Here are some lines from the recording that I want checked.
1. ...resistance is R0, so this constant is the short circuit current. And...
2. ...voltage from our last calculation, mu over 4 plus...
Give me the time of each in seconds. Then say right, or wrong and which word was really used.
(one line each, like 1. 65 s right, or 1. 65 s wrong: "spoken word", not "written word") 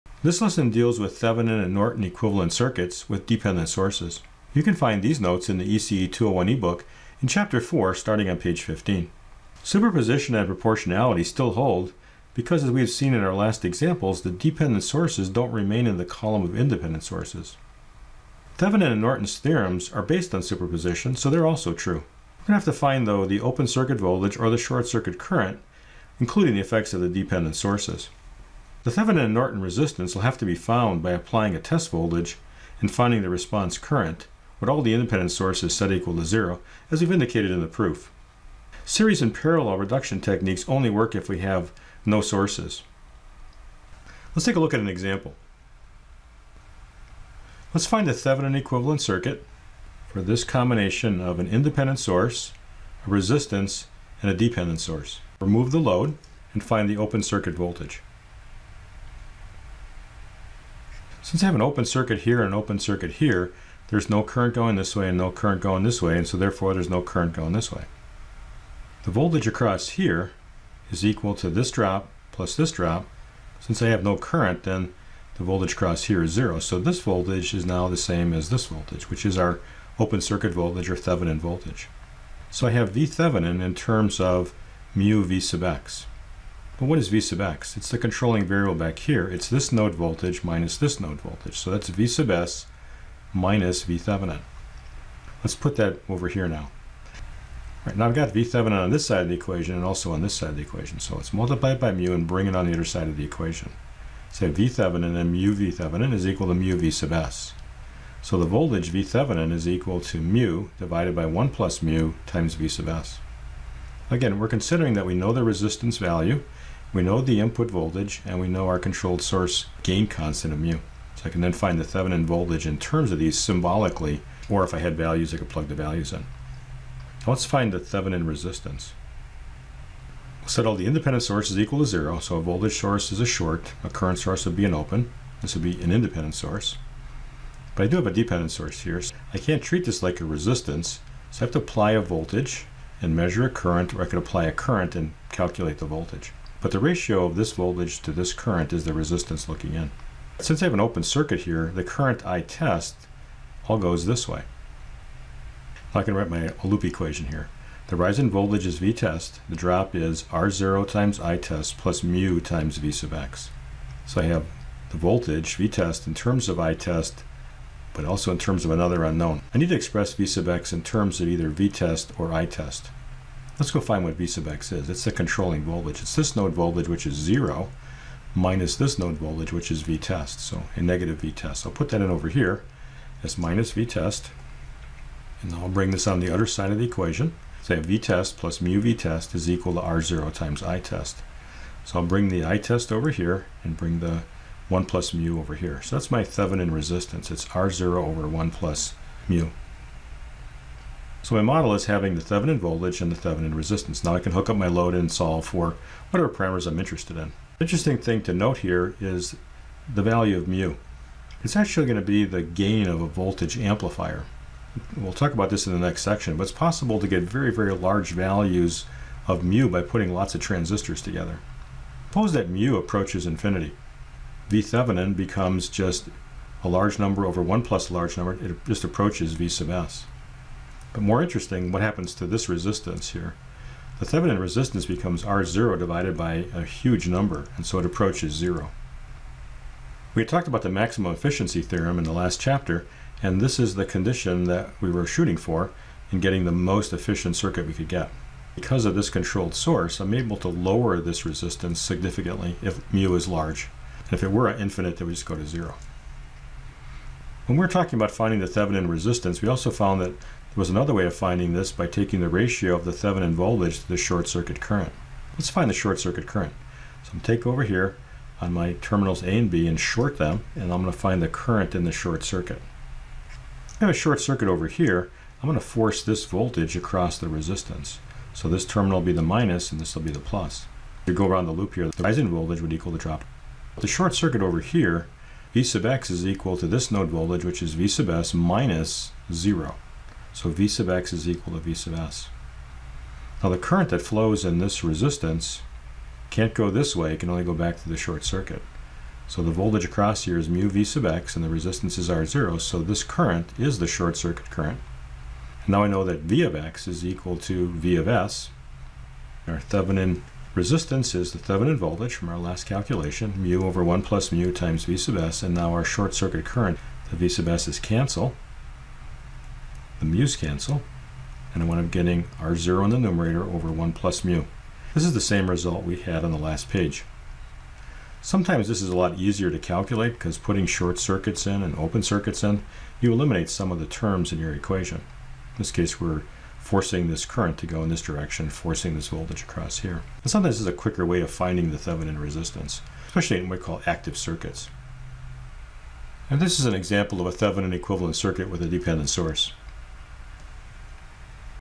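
1. 301 s wrong: "current", not "constant"
2. 311 s wrong: "1", not "4".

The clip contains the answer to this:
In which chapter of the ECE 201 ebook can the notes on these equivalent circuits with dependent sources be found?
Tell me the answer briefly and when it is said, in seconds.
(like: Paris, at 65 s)
Chapter 4, at 7 s.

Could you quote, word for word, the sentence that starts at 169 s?
I need to express V sub x in terms of either V test or I test.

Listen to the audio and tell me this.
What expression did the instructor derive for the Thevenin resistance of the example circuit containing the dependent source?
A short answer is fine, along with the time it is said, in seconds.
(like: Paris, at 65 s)
R0 over 1 plus mu, at 197 s.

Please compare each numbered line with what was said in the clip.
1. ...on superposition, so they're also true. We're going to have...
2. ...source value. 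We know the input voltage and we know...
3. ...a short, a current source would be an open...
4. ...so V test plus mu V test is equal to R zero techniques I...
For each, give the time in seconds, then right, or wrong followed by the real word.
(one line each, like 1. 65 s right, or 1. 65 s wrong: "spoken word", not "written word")
1. 20 s right
2. 115 s wrong: "resistance", not "source"
3. 133 s right
4. 187 s wrong: "times", not "techniques".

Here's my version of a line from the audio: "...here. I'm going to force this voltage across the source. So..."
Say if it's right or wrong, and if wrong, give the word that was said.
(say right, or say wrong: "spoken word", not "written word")
wrong: "resistance", not "source".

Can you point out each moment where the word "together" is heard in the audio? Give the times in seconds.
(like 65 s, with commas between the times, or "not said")
221 s.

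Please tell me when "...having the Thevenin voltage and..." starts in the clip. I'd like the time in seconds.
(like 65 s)
201 s.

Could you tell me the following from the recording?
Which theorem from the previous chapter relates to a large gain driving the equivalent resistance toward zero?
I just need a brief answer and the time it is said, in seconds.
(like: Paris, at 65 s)
maximum efficiency theorem, at 240 s.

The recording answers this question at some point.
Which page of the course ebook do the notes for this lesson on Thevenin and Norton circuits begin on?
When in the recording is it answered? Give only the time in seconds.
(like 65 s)
8 s.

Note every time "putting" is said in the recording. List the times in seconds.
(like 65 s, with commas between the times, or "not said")
219 s, 330 s.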